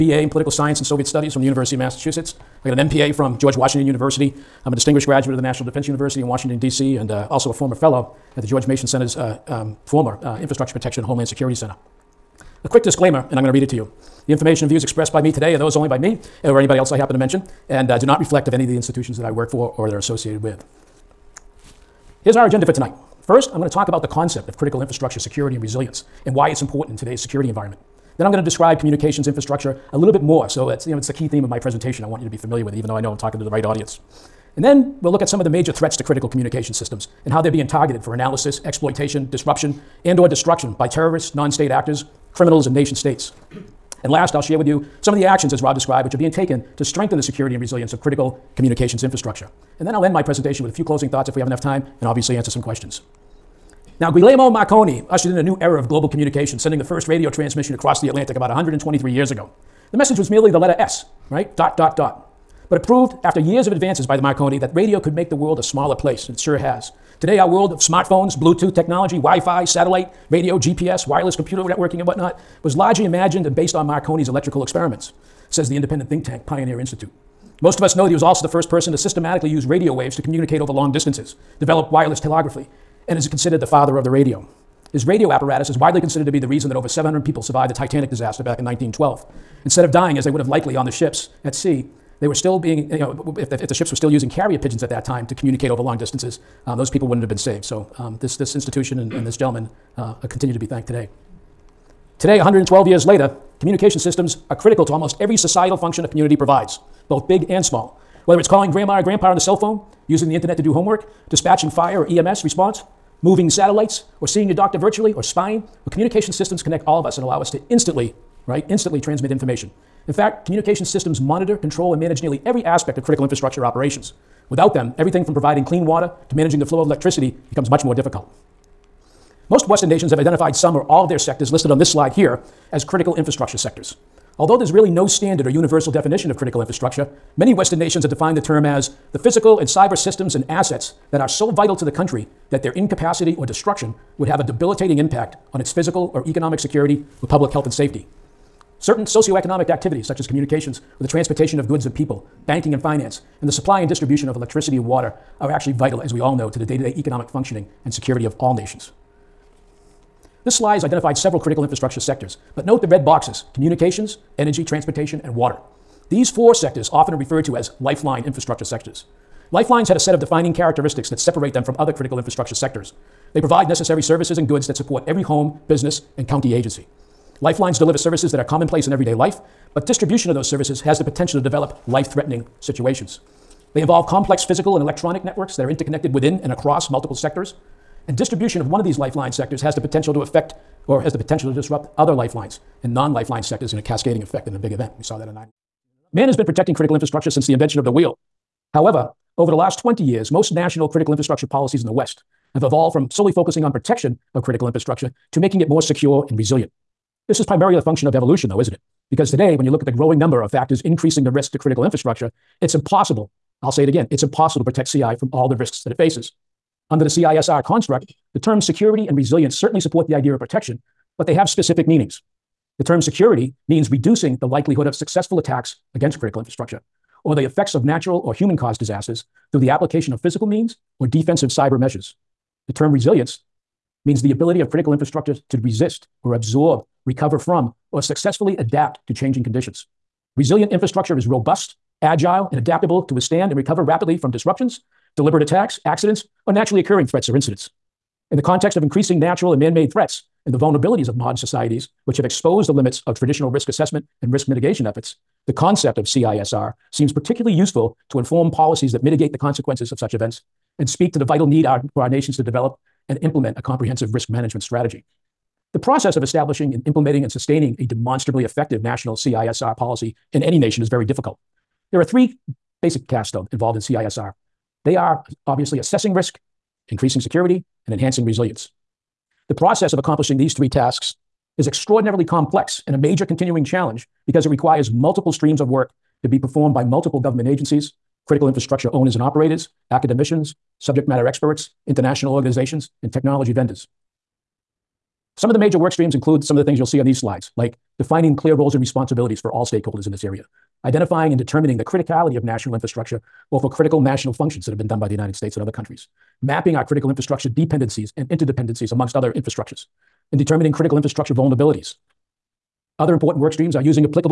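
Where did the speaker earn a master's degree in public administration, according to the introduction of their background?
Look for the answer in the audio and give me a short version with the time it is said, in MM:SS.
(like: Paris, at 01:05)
George Washington University, at 00:03.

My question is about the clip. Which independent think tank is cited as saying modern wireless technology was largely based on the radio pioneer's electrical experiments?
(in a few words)
Pioneer Institute.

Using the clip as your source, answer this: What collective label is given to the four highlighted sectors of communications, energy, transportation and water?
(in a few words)
lifeline infrastructure sectors.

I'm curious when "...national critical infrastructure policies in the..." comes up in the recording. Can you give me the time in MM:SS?
03:20.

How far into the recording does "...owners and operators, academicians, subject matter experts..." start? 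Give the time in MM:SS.
04:48.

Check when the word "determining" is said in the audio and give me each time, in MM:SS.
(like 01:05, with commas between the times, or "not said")
05:01, 05:10.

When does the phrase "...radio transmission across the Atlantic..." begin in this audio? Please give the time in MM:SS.
00:57.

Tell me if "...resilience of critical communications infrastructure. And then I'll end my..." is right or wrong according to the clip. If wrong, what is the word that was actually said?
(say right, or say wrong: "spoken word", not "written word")
right.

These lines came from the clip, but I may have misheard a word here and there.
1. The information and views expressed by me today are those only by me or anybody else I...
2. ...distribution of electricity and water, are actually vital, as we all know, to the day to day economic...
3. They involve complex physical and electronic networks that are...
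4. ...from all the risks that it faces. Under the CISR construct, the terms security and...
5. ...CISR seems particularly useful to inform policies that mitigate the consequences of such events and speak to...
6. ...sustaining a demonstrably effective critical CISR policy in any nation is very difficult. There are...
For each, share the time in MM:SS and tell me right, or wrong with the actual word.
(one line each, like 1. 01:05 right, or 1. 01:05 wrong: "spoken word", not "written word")
1. 00:14 right
2. 02:33 right
3. 03:03 right
4. 03:35 right
5. 04:16 right
6. 04:27 wrong: "national", not "critical".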